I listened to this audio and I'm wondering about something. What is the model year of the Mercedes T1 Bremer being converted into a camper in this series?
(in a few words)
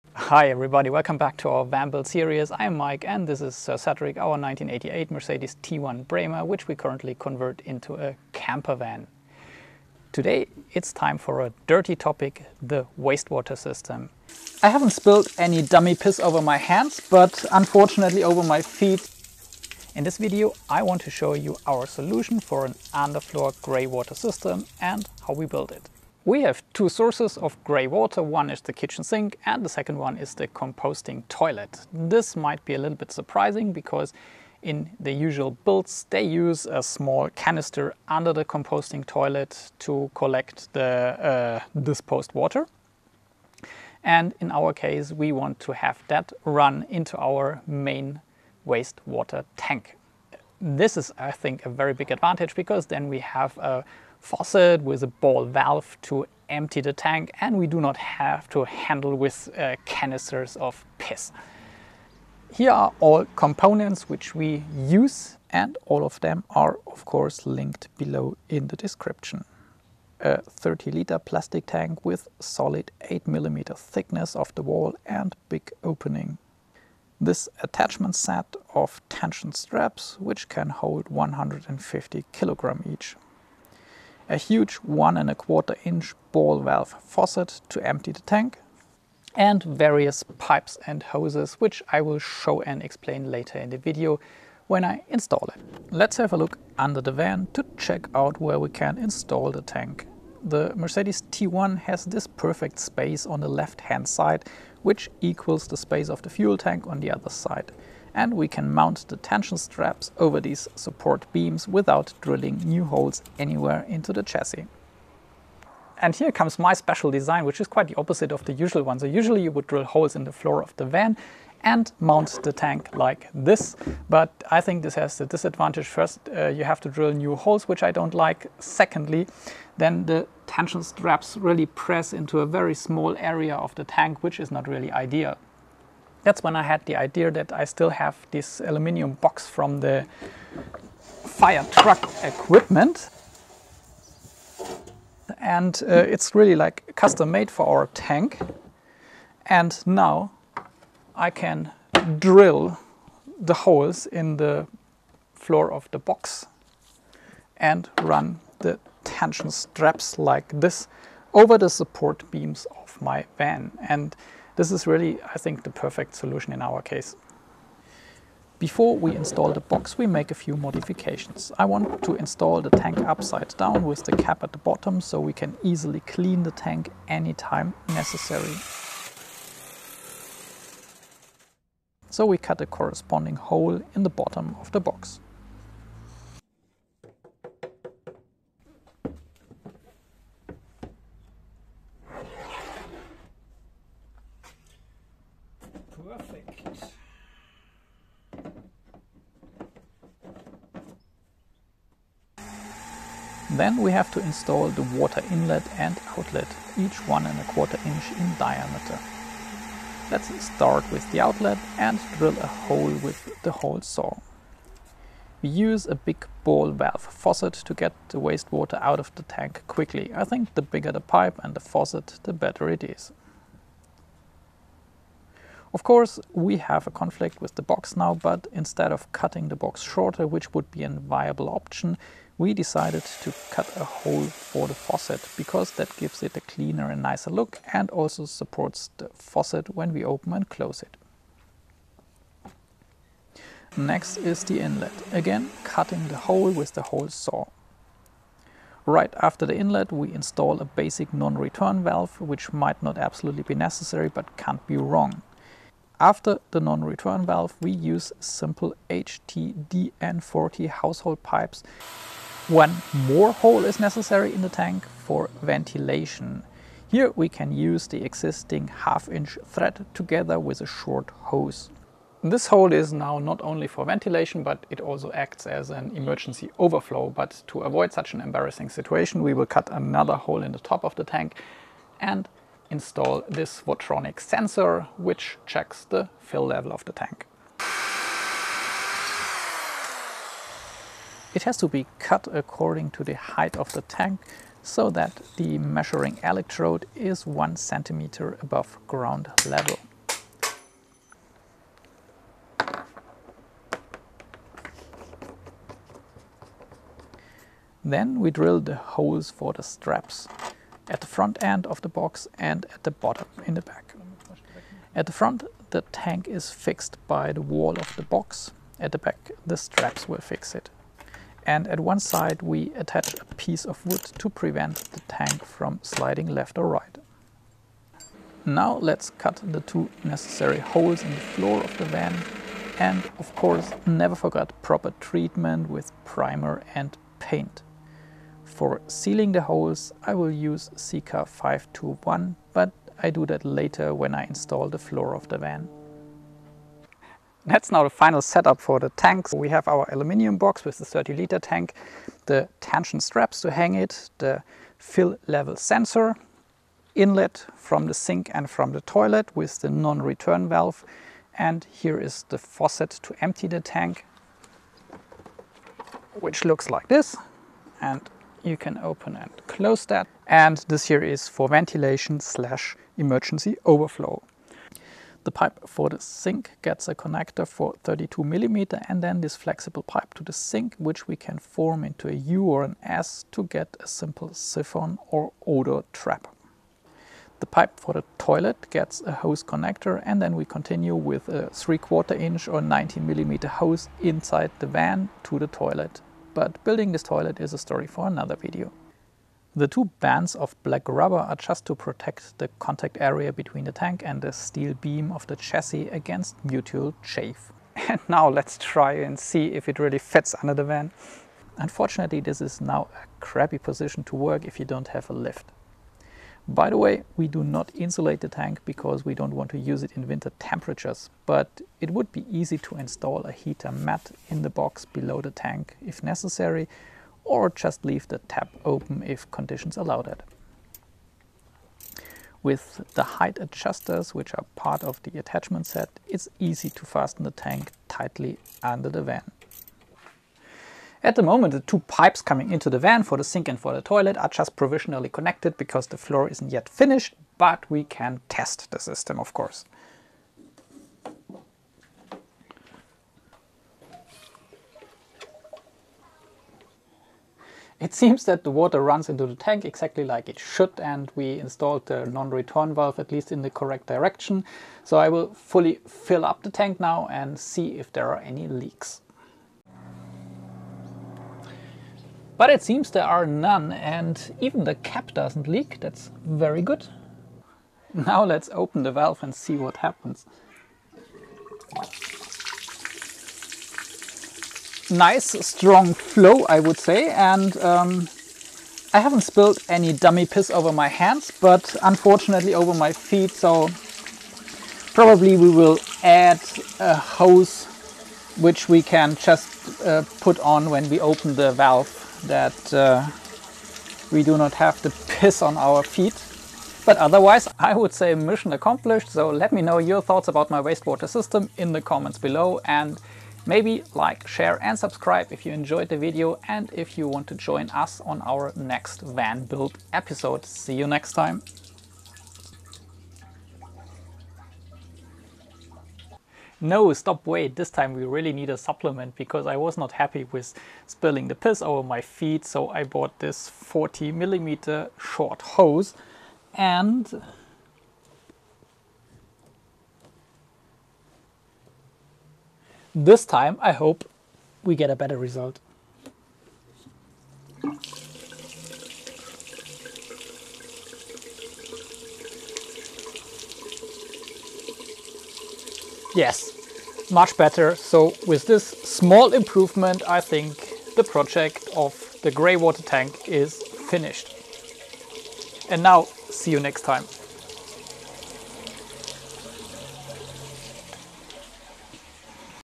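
1988.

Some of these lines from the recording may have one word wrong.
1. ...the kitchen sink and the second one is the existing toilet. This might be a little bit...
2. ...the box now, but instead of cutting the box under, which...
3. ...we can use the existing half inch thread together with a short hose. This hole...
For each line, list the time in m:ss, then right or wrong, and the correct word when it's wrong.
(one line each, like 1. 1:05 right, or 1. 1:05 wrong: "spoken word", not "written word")
1. 0:28 wrong: "composting", not "existing"
2. 3:47 wrong: "shorter", not "under"
3. 4:27 right.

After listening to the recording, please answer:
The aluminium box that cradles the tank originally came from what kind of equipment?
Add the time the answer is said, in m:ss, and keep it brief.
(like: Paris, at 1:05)
Fire truck equipment, at 2:21.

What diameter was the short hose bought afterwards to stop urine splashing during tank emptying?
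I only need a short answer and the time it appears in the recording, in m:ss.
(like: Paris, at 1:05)
40 millimeter, at 8:53.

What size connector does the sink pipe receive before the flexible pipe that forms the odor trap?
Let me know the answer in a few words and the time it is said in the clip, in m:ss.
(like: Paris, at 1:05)
32 millimeter, at 6:17.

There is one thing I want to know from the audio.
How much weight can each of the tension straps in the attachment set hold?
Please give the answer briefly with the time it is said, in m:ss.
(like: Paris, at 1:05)
150 kg, at 1:21.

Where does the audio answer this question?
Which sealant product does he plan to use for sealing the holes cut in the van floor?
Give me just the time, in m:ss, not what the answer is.
5:40.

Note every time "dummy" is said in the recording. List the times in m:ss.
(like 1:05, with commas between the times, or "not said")
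0:15, 8:09.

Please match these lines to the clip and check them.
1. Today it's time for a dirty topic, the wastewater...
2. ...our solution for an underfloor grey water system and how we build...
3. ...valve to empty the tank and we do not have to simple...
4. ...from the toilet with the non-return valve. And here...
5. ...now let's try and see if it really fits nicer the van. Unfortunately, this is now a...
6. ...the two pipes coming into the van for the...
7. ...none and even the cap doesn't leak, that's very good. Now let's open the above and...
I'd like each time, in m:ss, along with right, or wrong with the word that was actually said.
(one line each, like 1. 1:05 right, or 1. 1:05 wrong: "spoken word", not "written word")
1. 0:10 right
2. 0:21 right
3. 0:55 wrong: "handle", not "simple"
4. 5:58 right
5. 6:48 wrong: "under", not "nicer"
6. 7:21 right
7. 7:53 wrong: "valve", not "above".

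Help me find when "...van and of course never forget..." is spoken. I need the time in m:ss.
5:31.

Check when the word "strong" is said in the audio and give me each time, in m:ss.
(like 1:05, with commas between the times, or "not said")
8:05.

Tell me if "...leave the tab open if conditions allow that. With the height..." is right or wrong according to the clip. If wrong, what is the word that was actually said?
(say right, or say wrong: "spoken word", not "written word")
right.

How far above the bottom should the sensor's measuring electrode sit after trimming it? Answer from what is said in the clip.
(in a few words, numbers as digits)
1 centimeter.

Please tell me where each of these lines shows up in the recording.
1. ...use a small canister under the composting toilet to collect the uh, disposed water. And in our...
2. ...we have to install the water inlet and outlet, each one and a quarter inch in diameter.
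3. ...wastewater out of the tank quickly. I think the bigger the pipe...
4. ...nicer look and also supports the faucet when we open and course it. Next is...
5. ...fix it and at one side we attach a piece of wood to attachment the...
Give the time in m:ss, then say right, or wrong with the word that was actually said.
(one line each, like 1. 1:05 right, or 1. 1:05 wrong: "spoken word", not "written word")
1. 0:36 right
2. 3:23 right
3. 3:38 right
4. 3:56 wrong: "close", not "course"
5. 5:20 wrong: "prevent", not "attachment".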